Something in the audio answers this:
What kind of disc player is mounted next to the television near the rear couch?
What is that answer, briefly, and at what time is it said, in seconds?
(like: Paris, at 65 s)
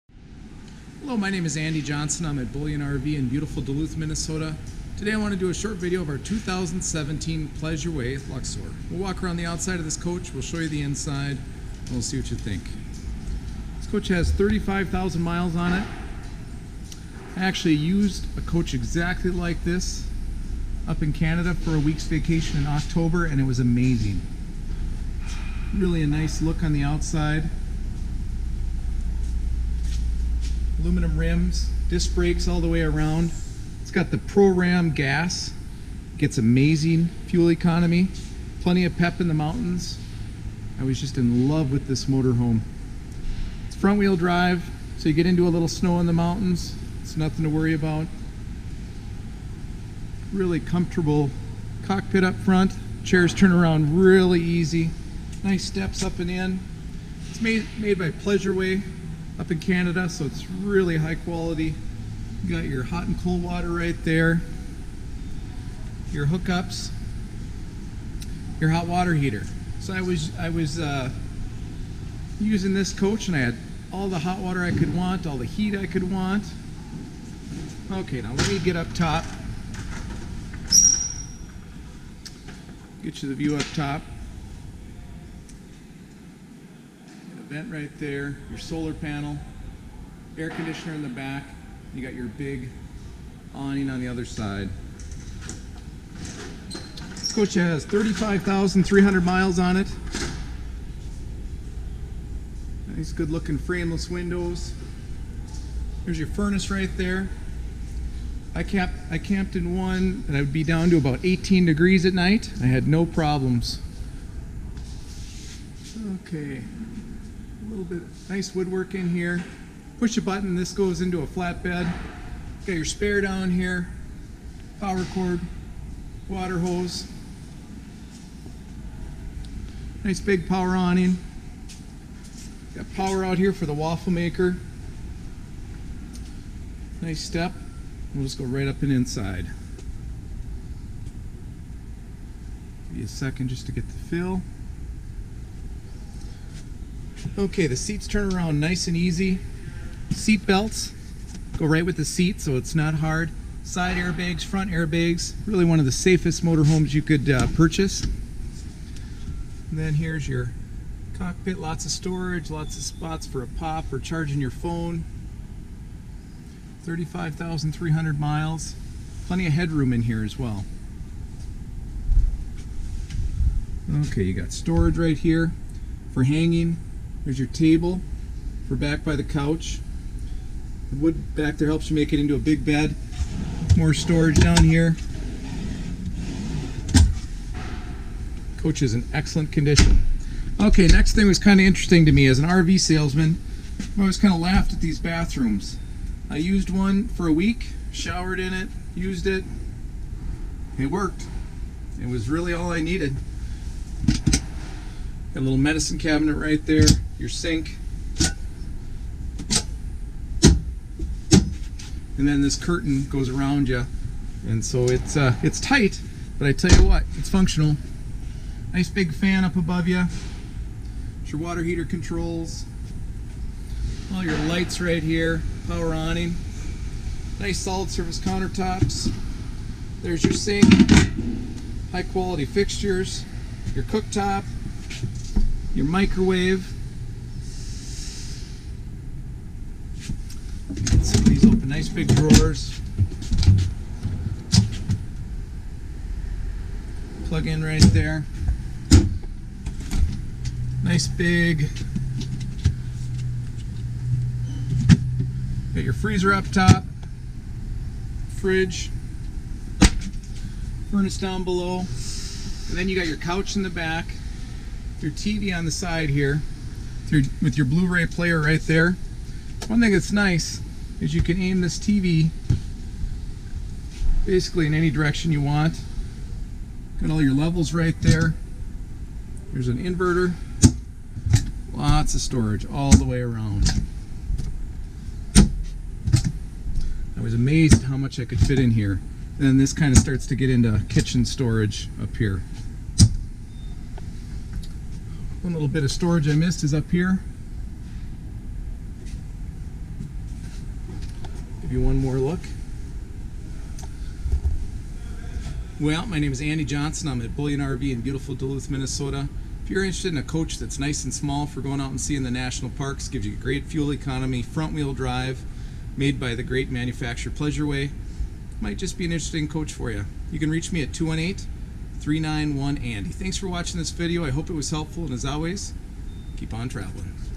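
Blu-ray player, at 267 s.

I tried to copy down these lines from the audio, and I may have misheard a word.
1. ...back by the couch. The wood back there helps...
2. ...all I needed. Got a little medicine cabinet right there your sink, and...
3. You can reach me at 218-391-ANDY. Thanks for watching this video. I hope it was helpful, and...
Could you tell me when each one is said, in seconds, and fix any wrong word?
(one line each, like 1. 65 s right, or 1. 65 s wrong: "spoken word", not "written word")
1. 178 s right
2. 202 s right
3. 320 s right.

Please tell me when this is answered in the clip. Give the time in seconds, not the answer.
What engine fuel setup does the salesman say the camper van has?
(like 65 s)
34 s.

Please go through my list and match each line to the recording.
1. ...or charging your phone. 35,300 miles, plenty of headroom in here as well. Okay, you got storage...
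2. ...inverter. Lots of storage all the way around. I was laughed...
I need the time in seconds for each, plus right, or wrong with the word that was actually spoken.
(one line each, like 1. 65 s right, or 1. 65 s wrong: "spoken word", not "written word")
1. 163 s right
2. 279 s wrong: "amazed", not "laughed".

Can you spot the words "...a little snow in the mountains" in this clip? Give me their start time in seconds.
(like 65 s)
45 s.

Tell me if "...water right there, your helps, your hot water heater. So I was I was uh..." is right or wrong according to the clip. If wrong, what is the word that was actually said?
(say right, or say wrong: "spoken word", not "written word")
wrong: "hookups", not "helps".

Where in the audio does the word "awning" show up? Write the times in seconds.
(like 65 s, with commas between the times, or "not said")
93 s, 130 s, 225 s.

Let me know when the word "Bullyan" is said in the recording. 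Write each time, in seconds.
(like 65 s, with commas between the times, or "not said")
2 s, 307 s.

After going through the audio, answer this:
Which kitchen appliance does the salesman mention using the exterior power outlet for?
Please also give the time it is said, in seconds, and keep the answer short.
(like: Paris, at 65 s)
waffle maker, at 133 s.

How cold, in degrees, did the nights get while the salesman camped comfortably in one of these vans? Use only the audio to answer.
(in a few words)
18 degrees.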